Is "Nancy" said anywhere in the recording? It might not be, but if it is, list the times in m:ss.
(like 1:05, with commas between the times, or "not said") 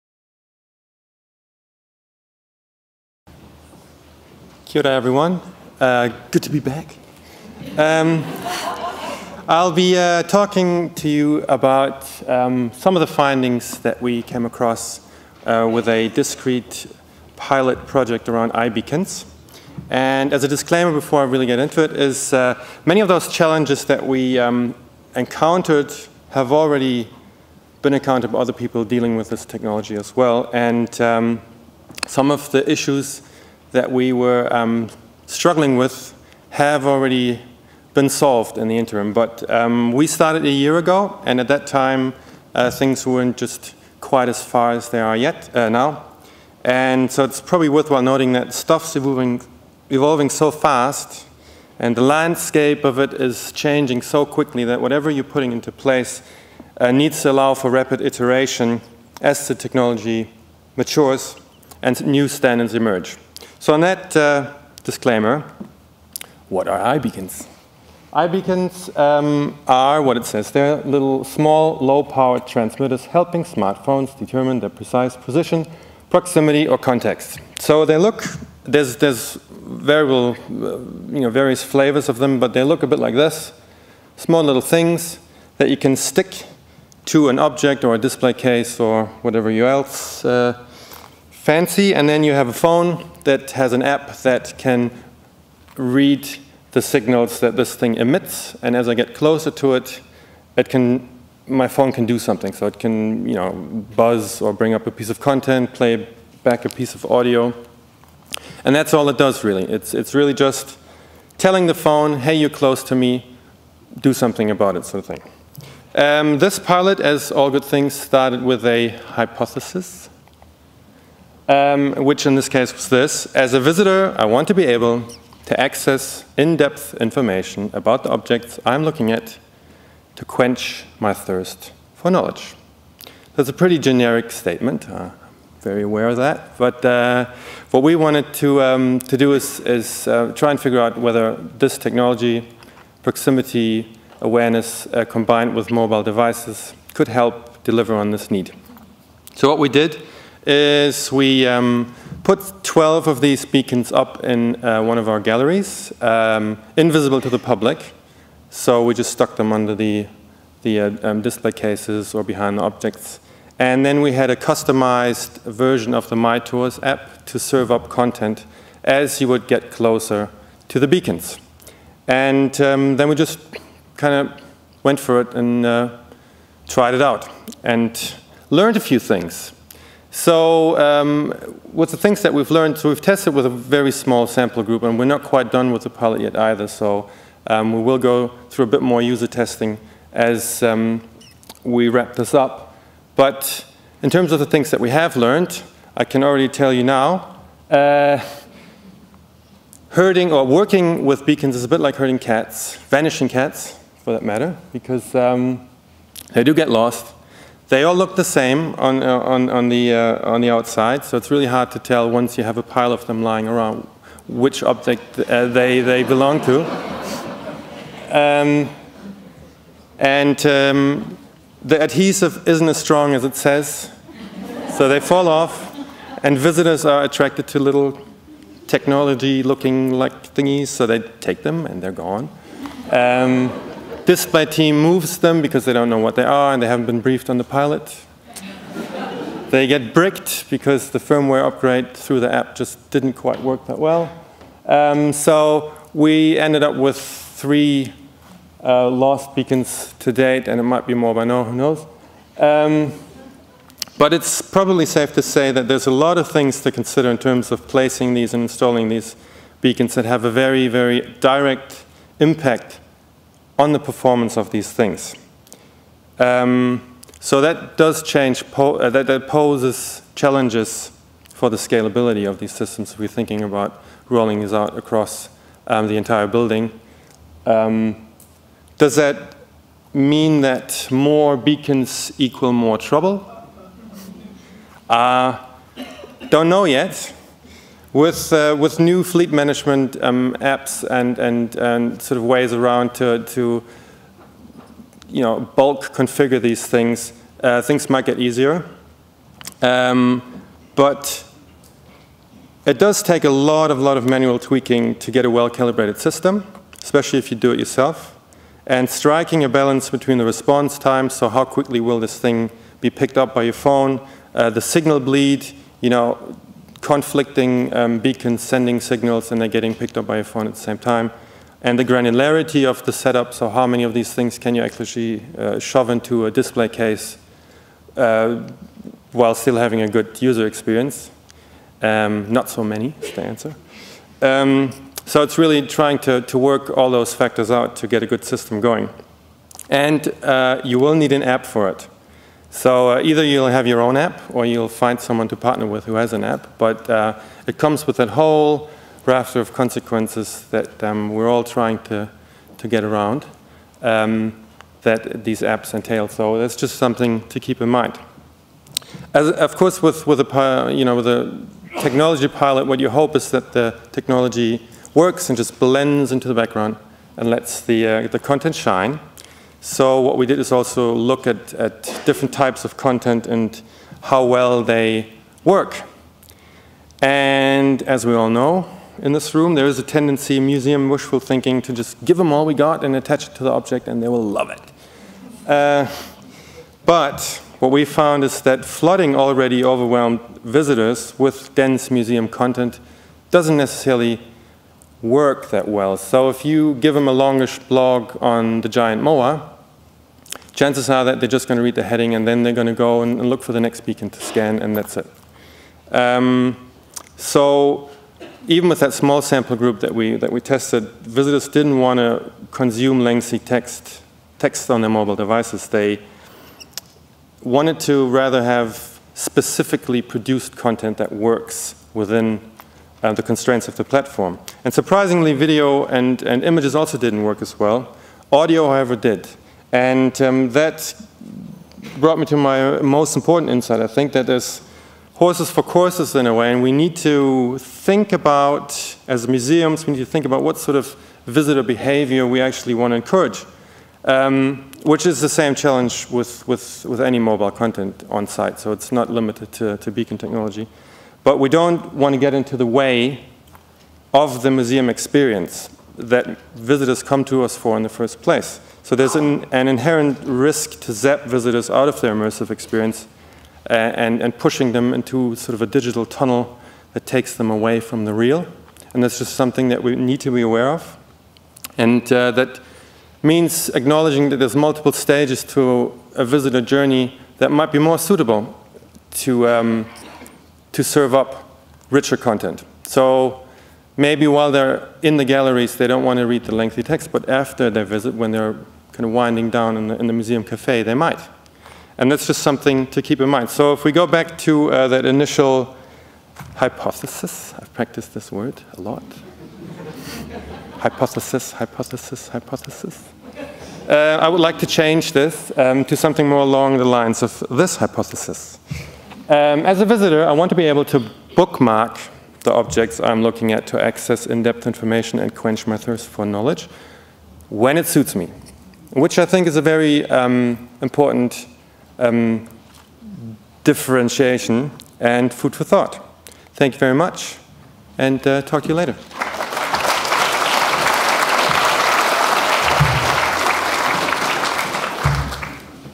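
not said.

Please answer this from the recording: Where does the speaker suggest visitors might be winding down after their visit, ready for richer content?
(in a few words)
museum cafe.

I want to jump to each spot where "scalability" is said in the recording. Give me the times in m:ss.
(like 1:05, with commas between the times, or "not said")
4:31.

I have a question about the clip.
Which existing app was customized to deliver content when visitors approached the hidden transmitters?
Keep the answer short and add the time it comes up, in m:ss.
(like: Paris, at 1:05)
My Tours, at 2:46.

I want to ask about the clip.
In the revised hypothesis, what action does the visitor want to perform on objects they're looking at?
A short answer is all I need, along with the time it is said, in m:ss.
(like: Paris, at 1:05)
bookmark, at 8:31.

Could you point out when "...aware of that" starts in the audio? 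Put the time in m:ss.
2:15.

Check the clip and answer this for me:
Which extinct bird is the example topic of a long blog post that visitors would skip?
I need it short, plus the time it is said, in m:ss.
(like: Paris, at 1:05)
giant moa, at 6:38.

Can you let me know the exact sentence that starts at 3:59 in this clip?
they get bricked because the firmware upgrade through the app just didn't quite work that well.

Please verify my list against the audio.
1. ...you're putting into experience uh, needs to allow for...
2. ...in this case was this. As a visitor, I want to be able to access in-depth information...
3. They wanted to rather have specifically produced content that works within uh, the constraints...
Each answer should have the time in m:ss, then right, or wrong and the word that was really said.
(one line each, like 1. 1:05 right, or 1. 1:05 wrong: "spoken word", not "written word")
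1. 0:55 wrong: "place", not "experience"
2. 2:02 right
3. 6:55 right.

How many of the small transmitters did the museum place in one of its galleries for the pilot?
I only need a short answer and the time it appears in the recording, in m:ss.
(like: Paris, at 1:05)
12, at 2:32.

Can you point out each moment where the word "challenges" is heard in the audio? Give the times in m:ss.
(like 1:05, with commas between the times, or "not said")
0:23, 4:30, 7:25.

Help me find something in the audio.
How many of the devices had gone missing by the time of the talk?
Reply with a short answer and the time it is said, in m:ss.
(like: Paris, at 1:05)
3, at 4:06.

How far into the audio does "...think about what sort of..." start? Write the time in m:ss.
7:20.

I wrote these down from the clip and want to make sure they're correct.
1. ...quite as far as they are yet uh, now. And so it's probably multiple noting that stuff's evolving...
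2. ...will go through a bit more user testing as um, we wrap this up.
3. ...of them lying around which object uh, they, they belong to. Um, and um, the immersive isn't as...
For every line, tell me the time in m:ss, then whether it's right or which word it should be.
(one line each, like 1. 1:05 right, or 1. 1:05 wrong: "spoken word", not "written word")
1. 0:43 wrong: "worthwhile", not "multiple"
2. 3:07 right
3. 3:32 wrong: "adhesive", not "immersive".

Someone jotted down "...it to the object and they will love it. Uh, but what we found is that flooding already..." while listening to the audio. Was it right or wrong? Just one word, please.
right.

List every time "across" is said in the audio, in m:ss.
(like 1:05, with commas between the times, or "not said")
0:14, 4:34.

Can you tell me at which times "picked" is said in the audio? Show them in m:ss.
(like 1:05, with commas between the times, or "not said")
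5:12, 5:19.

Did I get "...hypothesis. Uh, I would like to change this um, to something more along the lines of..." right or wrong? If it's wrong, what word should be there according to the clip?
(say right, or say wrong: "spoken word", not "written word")
right.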